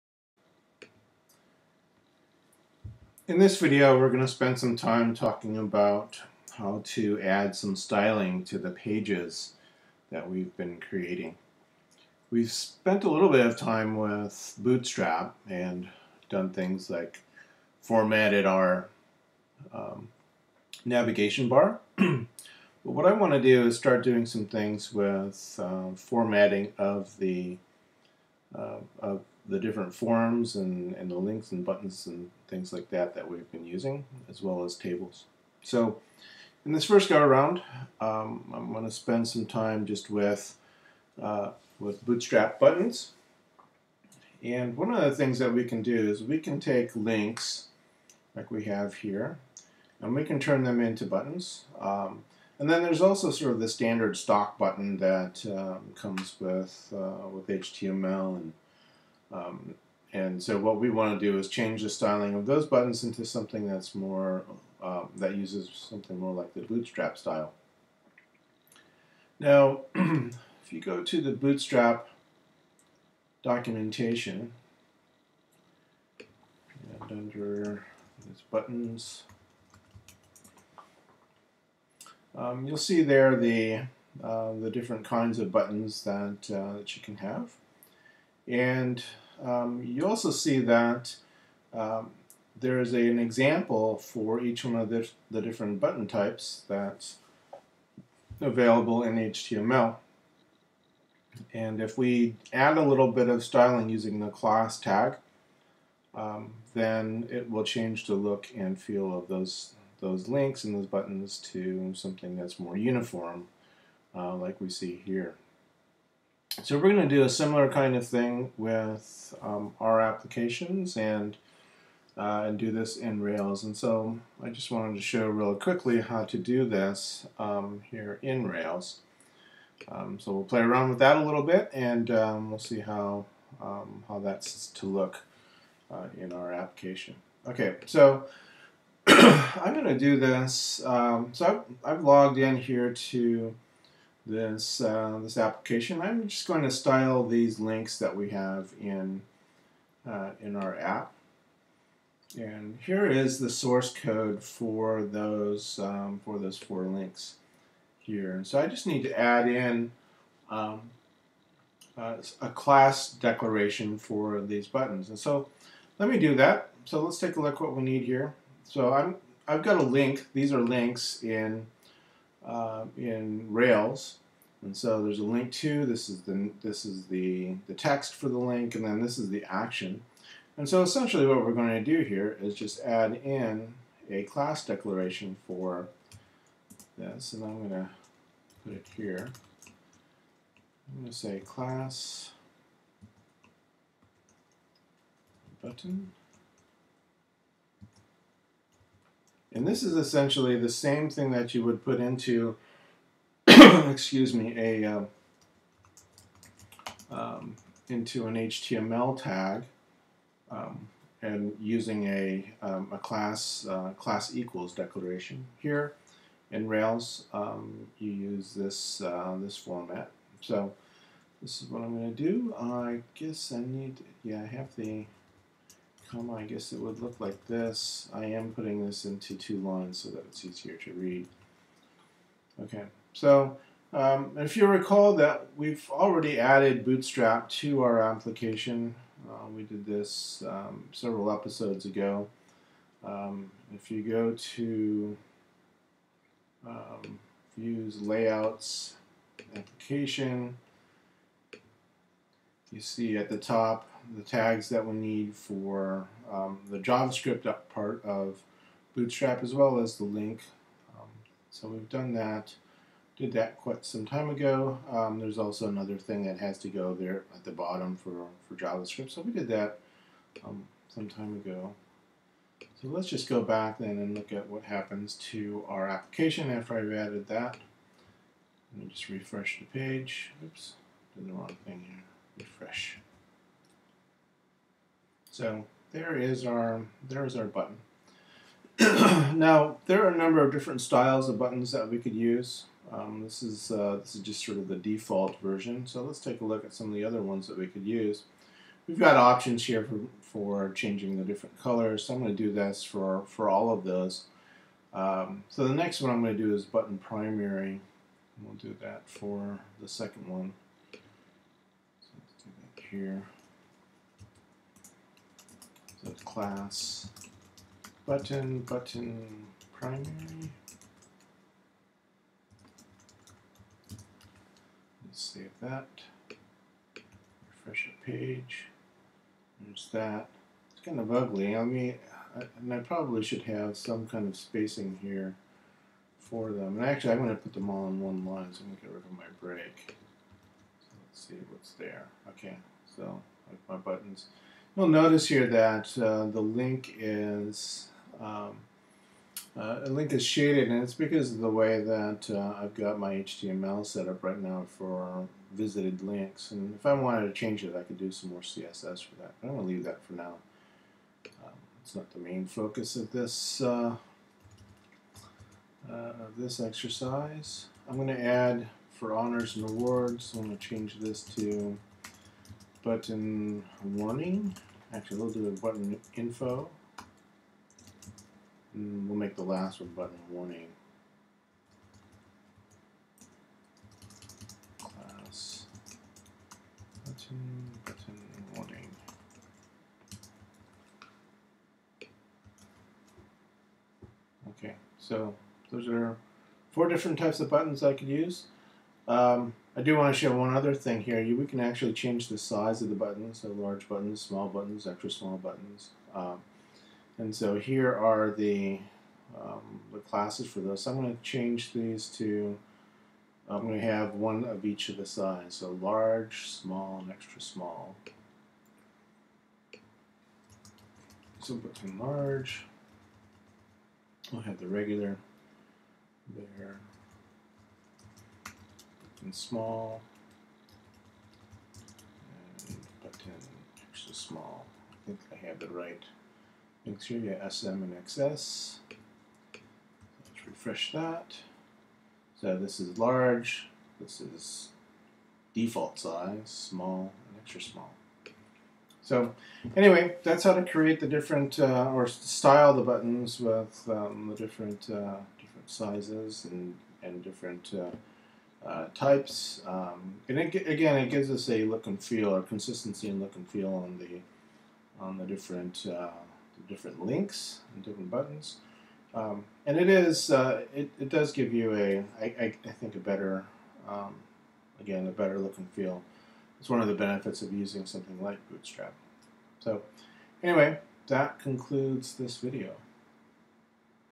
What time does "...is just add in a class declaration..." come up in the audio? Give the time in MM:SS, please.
03:02.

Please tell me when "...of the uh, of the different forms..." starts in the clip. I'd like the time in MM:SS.
00:26.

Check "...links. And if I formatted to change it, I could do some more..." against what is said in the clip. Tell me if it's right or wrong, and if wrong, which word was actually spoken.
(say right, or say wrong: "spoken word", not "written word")
wrong: "wanted", not "formatted".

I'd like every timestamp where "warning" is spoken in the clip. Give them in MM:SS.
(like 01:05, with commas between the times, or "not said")
06:13, 06:20, 06:28.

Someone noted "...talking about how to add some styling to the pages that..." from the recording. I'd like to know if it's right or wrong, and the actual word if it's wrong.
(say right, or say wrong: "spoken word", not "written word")
right.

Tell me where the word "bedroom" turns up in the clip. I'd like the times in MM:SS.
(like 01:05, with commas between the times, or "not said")
not said.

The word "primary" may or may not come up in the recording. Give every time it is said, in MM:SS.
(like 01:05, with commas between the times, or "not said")
05:06, 05:19.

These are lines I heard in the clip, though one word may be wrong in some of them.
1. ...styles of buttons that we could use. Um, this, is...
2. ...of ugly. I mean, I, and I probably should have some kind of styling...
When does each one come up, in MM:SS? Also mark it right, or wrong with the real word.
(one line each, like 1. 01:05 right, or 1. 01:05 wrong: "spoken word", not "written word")
1. 04:50 right
2. 05:30 wrong: "spacing", not "styling".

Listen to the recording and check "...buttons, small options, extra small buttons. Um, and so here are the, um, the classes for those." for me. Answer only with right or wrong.
wrong.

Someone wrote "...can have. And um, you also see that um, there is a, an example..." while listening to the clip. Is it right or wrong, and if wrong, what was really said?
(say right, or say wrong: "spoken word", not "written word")
right.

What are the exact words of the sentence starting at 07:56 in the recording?
It's one of the benefits of using something like Bootstrap.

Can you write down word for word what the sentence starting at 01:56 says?
So we're going to do a similar kind of thing with um, our applications and uh, and do this in Rails.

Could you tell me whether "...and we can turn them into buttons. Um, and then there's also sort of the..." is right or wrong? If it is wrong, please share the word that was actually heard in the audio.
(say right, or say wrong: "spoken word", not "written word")
right.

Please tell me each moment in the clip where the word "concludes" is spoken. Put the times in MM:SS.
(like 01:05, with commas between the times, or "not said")
08:01.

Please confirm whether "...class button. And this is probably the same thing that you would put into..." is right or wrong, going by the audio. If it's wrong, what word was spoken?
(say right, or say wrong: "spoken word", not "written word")
wrong: "essentially", not "probably".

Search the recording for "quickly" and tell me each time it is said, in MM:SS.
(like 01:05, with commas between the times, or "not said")
02:05.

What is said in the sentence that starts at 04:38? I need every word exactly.
Let me just refresh the page.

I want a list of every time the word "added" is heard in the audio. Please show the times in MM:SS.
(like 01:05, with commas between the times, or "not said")
03:56, 04:36.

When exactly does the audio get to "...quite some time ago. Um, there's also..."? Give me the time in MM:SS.
04:23.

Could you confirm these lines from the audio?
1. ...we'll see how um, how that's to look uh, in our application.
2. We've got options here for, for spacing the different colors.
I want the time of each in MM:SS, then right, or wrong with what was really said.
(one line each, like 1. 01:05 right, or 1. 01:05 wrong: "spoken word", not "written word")
1. 02:12 right
2. 04:58 wrong: "changing", not "spacing".